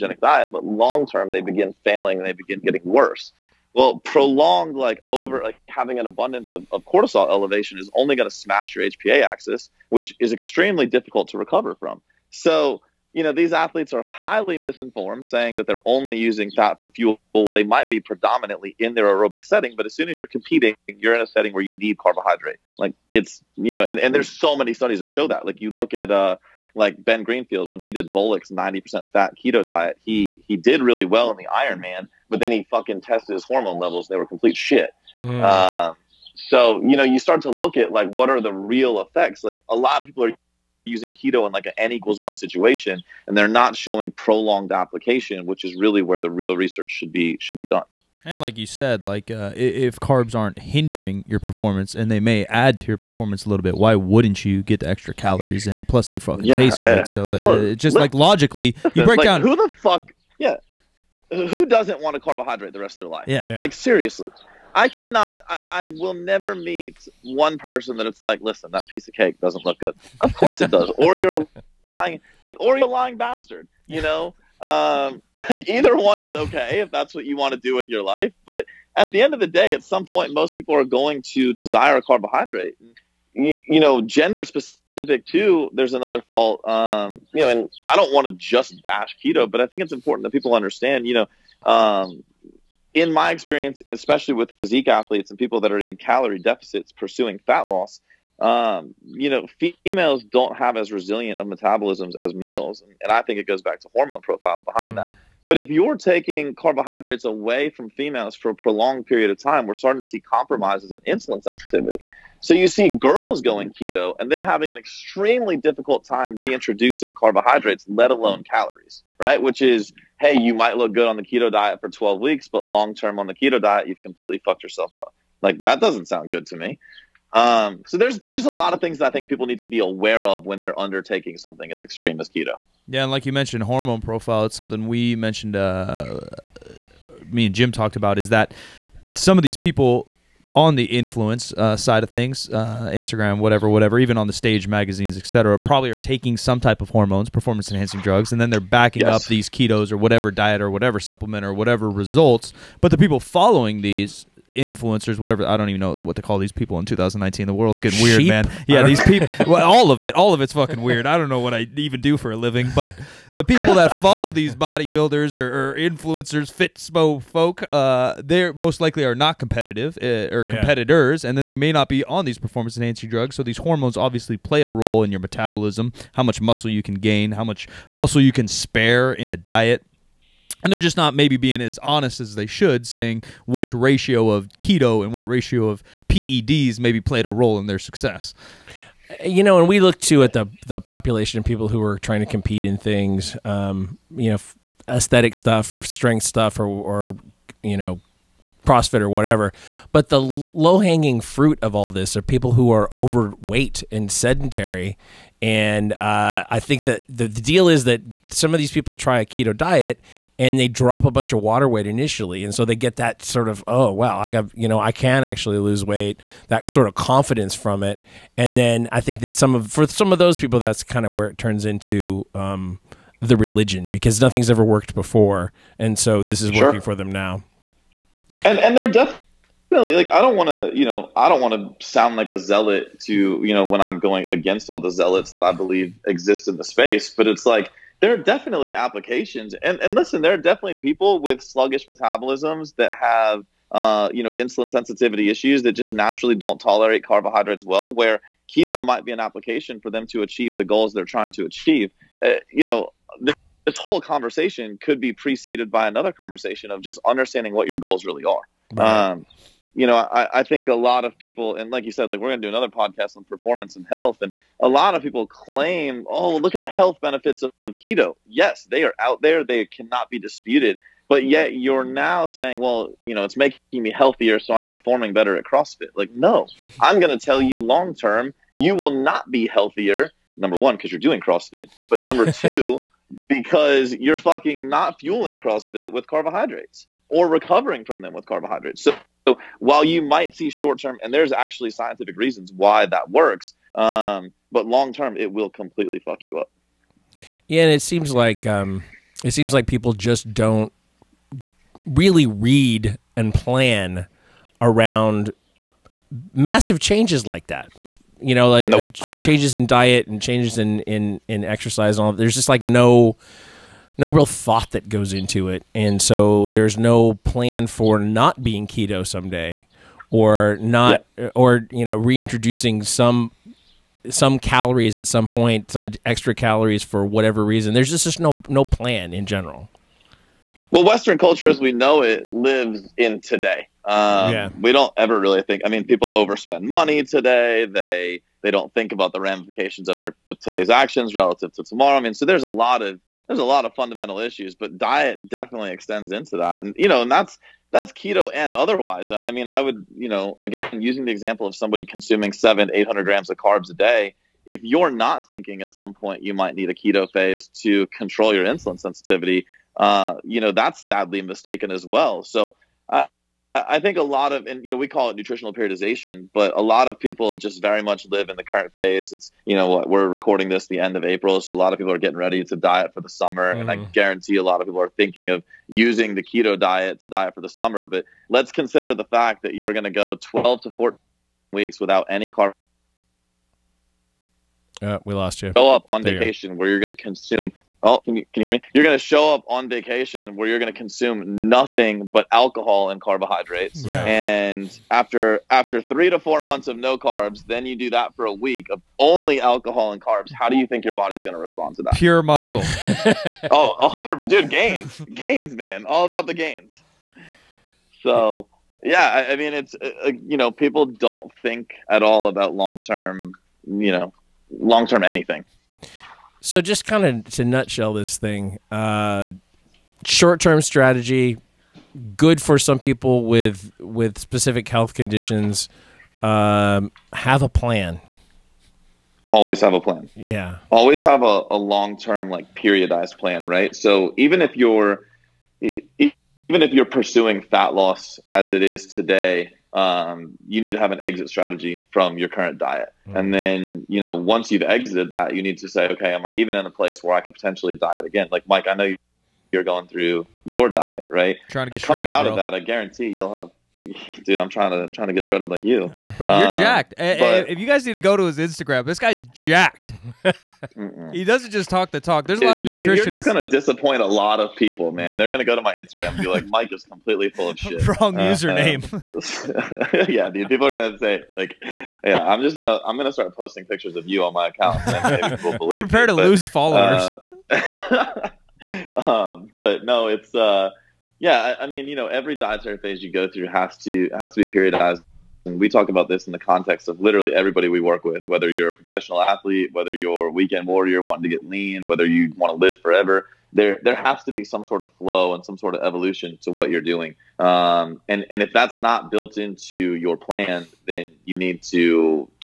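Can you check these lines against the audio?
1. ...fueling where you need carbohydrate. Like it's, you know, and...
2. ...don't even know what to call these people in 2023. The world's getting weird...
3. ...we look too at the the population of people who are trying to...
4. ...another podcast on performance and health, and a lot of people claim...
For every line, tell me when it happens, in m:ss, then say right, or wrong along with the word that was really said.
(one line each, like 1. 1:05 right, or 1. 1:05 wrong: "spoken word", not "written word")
1. 0:21 wrong: "setting", not "fueling"
2. 2:35 wrong: "2019", not "2023"
3. 3:09 right
4. 4:22 right.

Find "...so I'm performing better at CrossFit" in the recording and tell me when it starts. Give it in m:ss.
4:34.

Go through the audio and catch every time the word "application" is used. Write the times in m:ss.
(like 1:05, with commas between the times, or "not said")
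0:44, 3:58, 4:09.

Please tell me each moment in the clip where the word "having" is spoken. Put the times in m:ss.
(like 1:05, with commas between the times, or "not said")
0:05, 1:54.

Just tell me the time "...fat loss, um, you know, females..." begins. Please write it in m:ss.
1:37.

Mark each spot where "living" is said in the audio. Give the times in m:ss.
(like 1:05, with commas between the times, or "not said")
2:42.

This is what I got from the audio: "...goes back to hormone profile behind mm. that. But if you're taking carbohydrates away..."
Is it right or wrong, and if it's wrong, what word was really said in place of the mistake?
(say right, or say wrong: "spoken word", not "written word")
right.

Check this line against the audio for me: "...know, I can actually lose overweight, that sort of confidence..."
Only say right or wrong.
wrong.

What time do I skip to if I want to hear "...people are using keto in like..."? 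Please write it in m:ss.
0:40.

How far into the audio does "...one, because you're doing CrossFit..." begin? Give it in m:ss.
4:40.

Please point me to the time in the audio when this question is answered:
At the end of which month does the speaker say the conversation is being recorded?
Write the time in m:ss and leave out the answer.
6:11.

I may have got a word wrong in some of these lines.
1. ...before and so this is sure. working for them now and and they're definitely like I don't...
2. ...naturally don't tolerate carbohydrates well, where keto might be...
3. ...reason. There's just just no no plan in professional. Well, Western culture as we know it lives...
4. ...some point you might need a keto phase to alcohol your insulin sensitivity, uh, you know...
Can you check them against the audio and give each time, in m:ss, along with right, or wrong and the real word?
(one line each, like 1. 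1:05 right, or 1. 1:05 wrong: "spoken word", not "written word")
1. 3:44 right
2. 4:05 right
3. 5:27 wrong: "general", not "professional"
4. 5:55 wrong: "control", not "alcohol".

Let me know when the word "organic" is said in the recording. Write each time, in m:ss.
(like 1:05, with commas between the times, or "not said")
not said.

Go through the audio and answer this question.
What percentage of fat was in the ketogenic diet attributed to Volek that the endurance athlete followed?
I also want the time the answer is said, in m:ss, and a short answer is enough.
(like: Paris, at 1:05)
90%, at 0:28.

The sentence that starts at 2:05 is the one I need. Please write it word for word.
Like that doesn't sound good to me.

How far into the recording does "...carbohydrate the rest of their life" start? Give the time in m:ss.
1:02.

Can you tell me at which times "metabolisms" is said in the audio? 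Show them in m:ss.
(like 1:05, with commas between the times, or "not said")
1:41, 2:55, 4:01.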